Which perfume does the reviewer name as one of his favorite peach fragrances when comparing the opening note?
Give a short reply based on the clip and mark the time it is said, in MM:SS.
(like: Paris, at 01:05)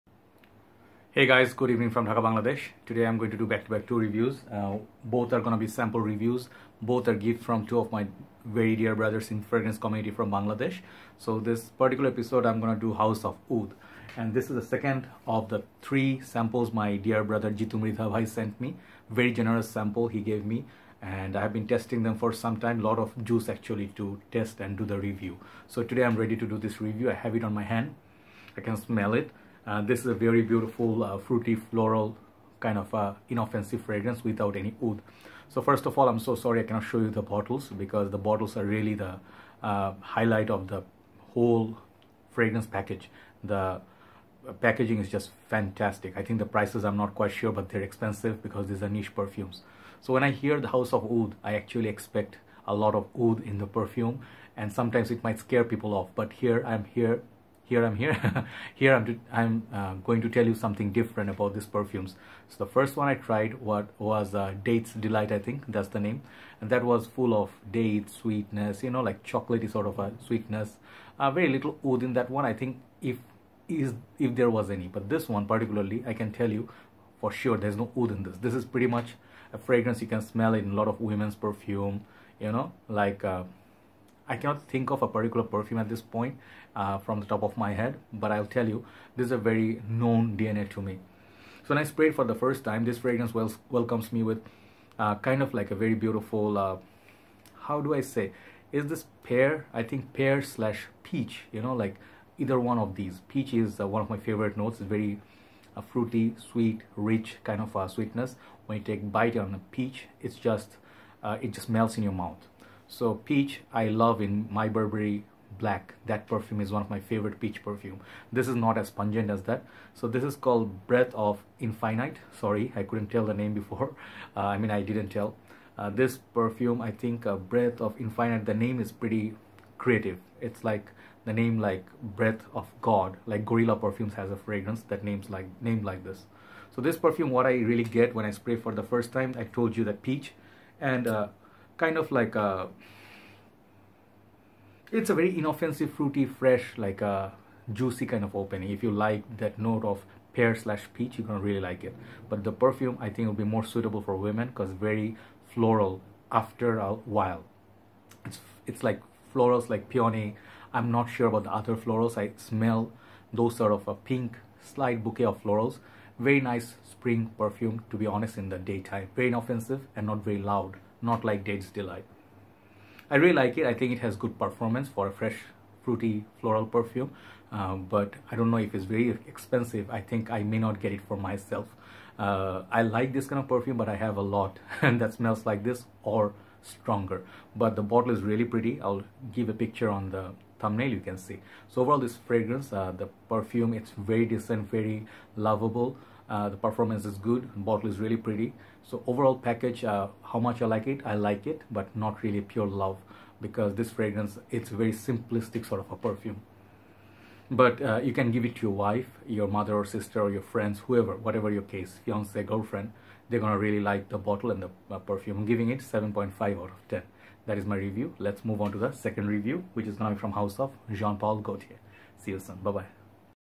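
My Burberry Black, at 01:54.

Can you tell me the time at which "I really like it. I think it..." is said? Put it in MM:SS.
02:53.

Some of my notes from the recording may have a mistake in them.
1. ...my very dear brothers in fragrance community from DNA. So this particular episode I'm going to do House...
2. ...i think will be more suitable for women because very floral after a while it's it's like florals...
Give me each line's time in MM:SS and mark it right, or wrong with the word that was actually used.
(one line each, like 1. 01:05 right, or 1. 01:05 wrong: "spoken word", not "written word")
1. 00:07 wrong: "Bangladesh", not "DNA"
2. 02:33 right.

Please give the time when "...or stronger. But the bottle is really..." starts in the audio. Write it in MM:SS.
03:06.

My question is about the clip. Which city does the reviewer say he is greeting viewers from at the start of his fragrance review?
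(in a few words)
Dhaka.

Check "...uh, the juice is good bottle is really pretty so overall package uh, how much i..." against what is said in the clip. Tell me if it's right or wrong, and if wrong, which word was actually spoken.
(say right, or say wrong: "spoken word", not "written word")
wrong: "performance", not "juice".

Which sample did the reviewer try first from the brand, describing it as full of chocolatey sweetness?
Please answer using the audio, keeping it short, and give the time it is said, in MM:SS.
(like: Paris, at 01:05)
Dates Delight, at 01:04.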